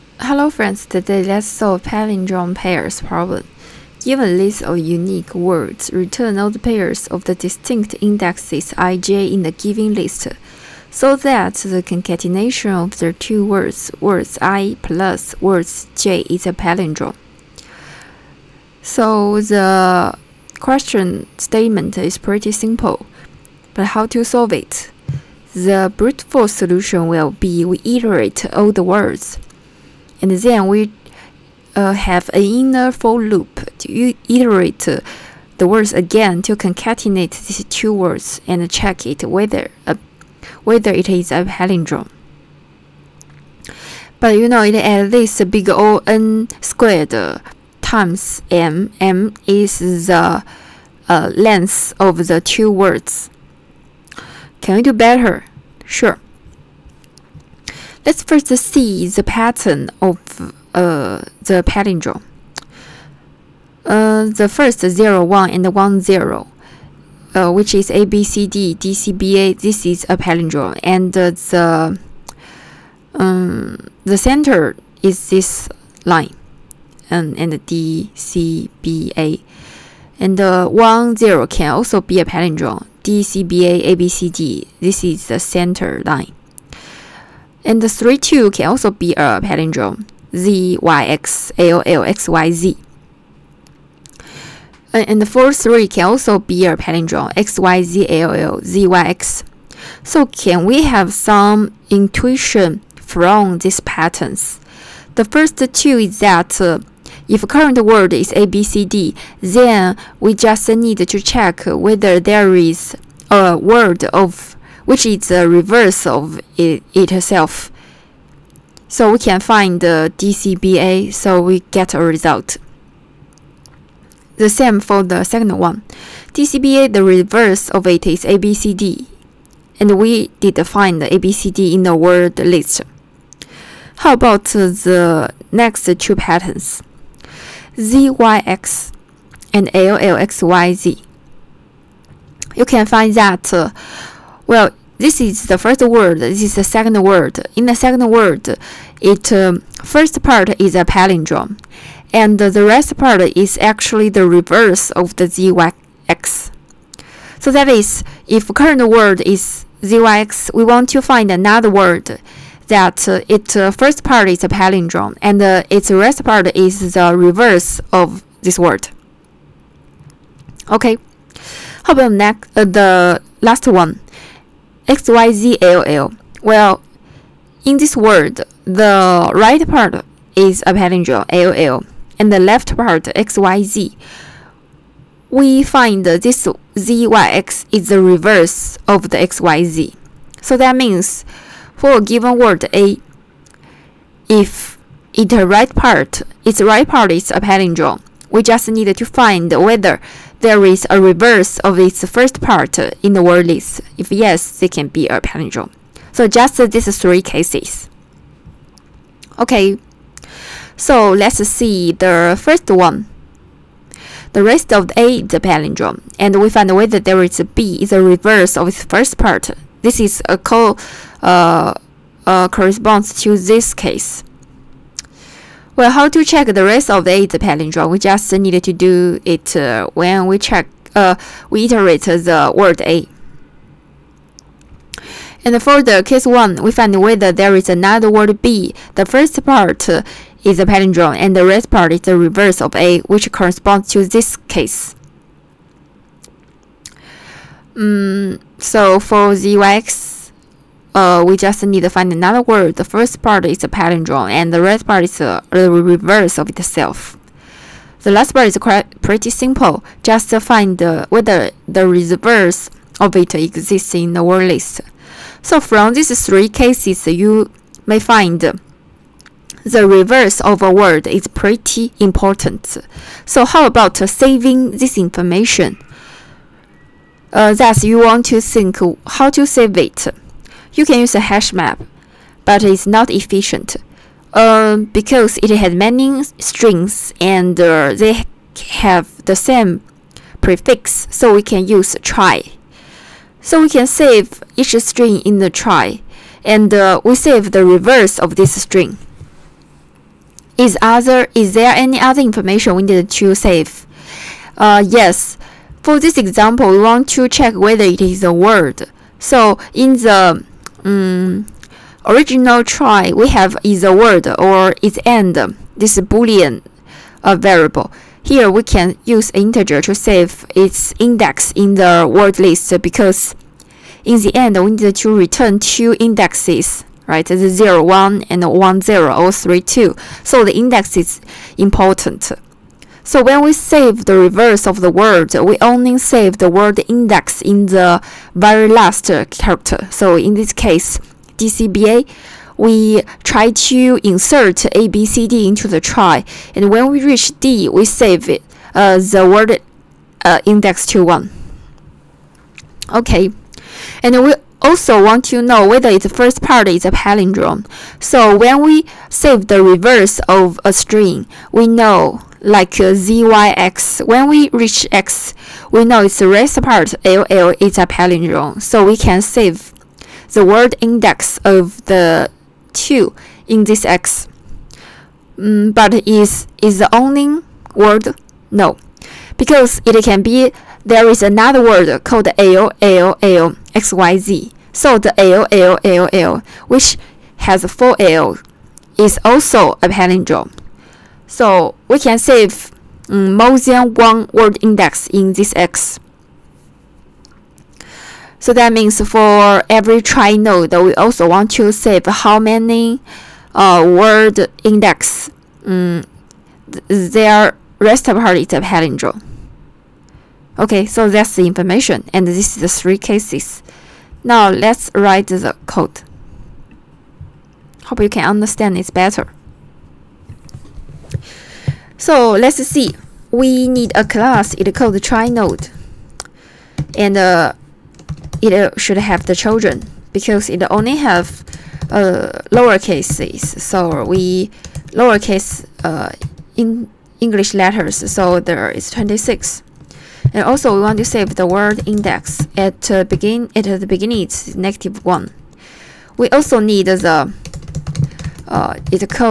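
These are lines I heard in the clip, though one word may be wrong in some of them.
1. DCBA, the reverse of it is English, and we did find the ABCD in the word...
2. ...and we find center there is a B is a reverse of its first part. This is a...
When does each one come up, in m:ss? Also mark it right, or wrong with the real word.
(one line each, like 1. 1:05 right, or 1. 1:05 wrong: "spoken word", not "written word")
1. 2:06 wrong: "ABCD", not "English"
2. 3:36 wrong: "whether", not "center".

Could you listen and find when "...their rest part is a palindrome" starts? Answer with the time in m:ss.
6:47.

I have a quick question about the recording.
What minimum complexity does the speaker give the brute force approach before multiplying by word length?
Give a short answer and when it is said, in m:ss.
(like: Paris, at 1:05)
big O n squared, at 0:45.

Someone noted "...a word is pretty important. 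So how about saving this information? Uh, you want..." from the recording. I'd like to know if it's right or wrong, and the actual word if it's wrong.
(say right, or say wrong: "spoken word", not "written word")
right.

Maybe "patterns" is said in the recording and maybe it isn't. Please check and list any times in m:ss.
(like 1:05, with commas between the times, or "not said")
0:59, 1:43, 2:16.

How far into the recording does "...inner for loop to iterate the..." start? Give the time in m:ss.
0:32.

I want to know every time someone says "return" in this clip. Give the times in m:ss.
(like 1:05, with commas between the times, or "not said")
0:05, 5:25.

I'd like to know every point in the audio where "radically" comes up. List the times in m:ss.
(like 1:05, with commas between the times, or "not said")
not said.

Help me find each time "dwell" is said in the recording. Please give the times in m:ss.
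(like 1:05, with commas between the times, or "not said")
not said.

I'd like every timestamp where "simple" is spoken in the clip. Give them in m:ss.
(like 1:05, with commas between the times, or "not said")
0:22, 4:19.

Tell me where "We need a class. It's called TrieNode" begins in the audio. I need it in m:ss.
7:03.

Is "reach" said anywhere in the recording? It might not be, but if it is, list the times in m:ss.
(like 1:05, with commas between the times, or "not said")
5:47, 6:04.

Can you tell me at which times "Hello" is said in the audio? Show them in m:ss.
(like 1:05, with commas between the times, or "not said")
0:00.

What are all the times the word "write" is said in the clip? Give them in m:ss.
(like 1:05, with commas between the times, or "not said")
6:54.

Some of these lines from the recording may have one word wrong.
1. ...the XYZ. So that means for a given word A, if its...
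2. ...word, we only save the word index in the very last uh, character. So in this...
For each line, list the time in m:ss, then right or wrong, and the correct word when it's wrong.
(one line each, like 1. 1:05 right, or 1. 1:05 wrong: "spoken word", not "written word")
1. 3:09 right
2. 5:34 right.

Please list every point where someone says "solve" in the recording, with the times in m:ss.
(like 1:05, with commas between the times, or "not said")
0:01, 0:24.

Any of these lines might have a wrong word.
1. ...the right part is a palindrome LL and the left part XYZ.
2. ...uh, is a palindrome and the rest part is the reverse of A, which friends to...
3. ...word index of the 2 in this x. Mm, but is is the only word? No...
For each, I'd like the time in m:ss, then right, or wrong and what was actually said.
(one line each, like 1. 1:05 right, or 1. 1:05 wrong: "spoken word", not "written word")
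1. 2:58 right
2. 3:59 wrong: "corresponds", not "friends"
3. 6:10 right.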